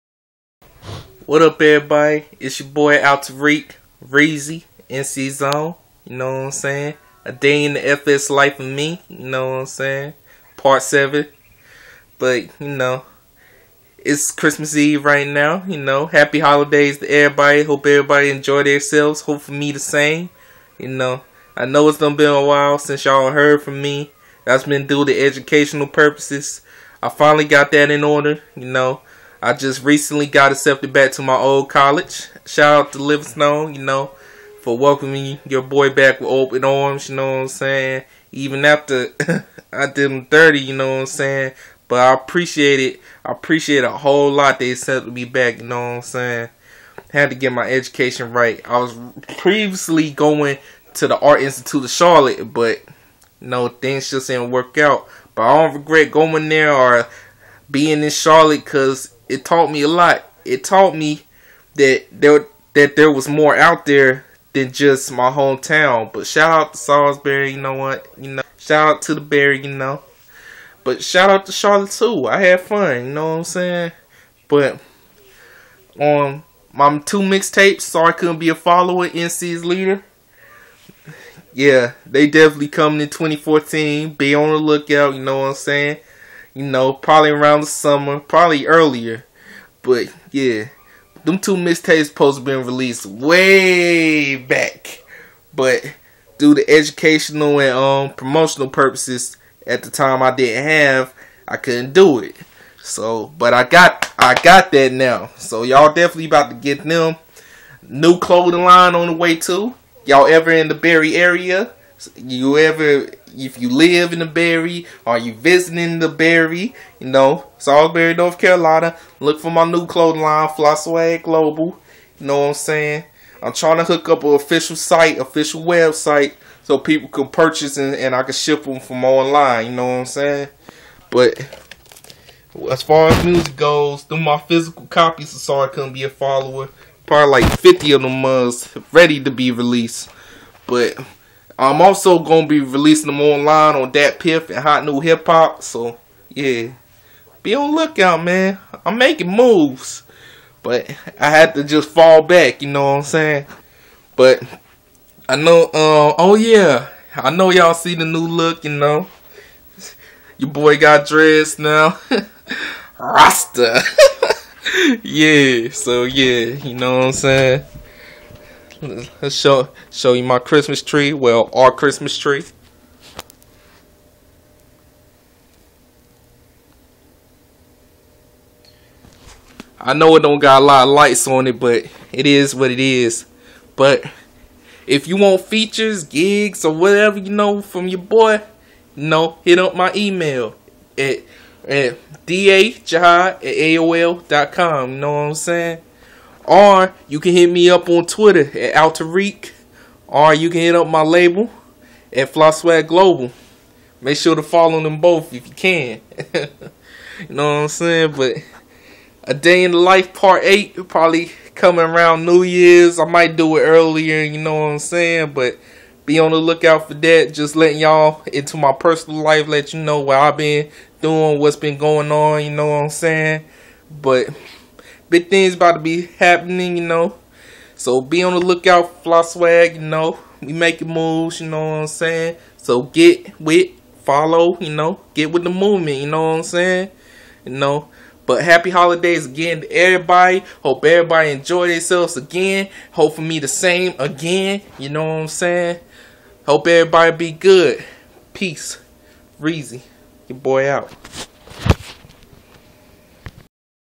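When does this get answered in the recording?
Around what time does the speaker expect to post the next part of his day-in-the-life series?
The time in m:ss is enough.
3:32.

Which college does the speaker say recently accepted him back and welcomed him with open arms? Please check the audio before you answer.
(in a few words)
Livingstone.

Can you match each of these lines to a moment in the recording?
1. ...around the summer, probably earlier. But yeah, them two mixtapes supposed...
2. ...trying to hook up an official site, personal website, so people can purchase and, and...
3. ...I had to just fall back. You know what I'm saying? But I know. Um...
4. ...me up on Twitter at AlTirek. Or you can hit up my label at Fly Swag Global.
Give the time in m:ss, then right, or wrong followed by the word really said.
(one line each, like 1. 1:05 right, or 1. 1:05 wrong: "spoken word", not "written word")
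1. 1:27 right
2. 2:03 wrong: "official", not "personal"
3. 2:31 right
4. 3:17 right.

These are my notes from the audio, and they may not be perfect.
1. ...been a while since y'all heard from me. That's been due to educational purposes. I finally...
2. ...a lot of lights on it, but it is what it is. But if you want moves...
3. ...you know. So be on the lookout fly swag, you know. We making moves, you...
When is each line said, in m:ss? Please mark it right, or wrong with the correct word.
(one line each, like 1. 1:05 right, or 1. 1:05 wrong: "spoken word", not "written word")
1. 0:22 right
2. 3:00 wrong: "features", not "moves"
3. 3:46 right.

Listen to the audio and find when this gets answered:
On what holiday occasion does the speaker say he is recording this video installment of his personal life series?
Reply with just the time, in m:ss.
0:14.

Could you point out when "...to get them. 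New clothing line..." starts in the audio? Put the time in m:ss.
1:46.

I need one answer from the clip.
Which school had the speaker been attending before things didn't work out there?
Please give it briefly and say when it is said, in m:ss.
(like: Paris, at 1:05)
Art Institute of Charlotte, at 0:51.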